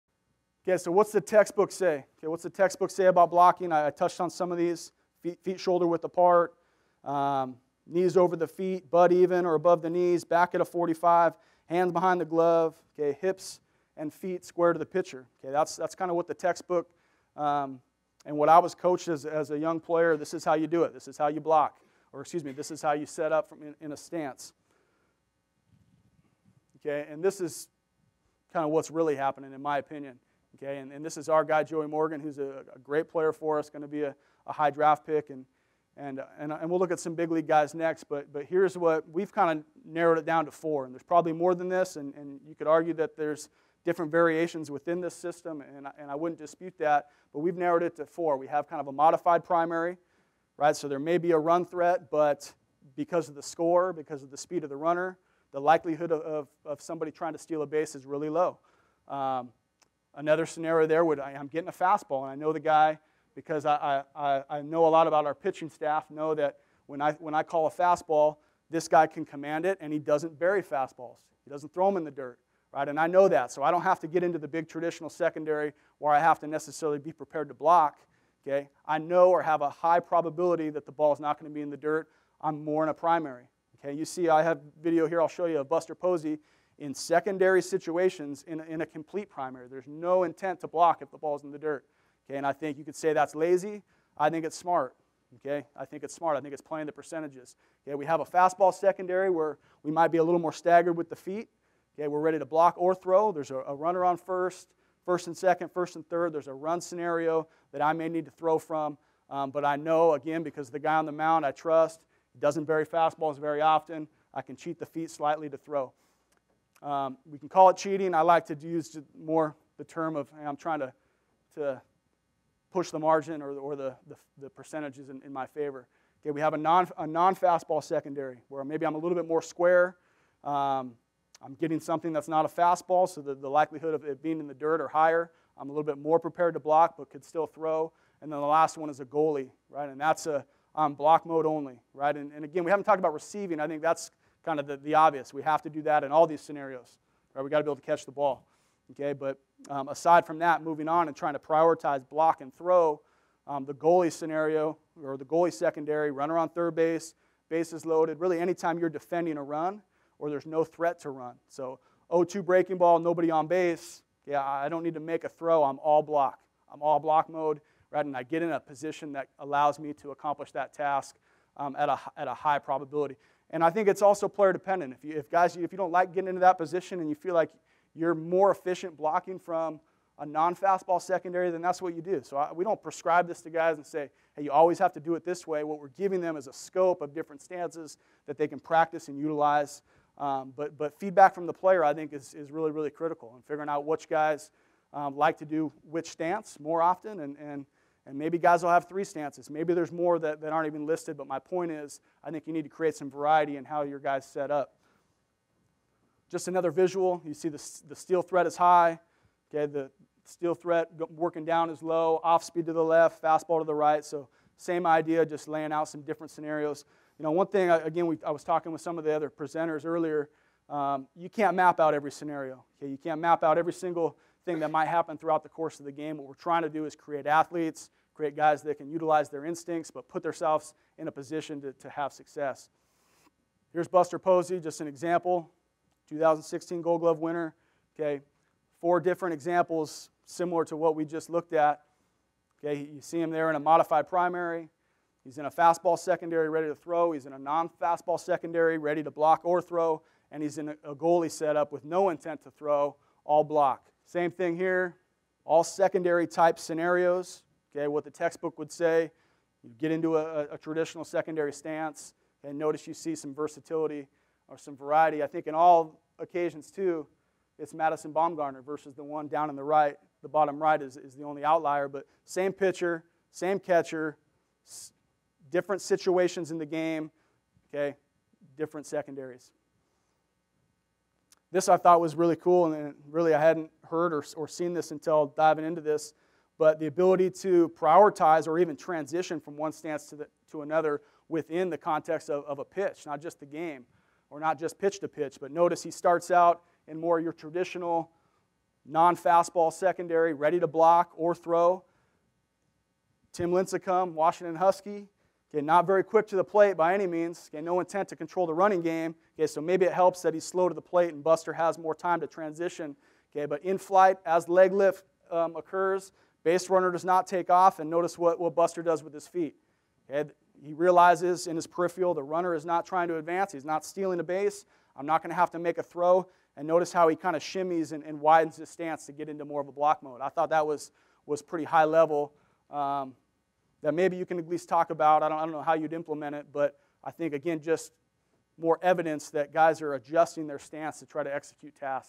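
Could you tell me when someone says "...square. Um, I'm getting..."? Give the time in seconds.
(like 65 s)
129 s.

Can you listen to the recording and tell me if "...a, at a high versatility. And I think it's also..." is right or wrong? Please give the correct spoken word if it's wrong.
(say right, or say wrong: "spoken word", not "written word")
wrong: "probability", not "versatility".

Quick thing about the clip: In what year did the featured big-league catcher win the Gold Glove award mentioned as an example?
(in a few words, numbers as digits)
2016.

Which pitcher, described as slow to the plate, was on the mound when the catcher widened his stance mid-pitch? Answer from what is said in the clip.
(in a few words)
Tim Lincecum.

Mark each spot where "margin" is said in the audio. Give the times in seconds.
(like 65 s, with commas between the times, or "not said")
122 s.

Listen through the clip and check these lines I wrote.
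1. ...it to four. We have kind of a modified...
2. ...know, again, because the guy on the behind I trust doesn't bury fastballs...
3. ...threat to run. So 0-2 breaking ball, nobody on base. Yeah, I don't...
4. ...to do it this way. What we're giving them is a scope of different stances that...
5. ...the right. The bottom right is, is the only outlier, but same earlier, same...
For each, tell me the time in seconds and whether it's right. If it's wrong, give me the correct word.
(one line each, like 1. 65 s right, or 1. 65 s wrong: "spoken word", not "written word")
1. 47 s right
2. 109 s wrong: "mound", not "behind"
3. 160 s right
4. 184 s right
5. 269 s wrong: "pitcher", not "earlier".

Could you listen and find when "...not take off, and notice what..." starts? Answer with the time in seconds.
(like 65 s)
317 s.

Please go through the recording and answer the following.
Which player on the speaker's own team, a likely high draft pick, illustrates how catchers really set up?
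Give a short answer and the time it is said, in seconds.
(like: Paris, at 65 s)
Joey Morgan, at 31 s.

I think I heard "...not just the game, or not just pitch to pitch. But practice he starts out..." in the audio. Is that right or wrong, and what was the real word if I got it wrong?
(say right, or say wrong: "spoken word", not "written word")
wrong: "notice", not "practice".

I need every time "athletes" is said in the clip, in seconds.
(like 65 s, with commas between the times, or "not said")
227 s.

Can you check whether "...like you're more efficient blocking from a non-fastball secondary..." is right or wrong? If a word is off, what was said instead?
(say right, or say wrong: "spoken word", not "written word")
right.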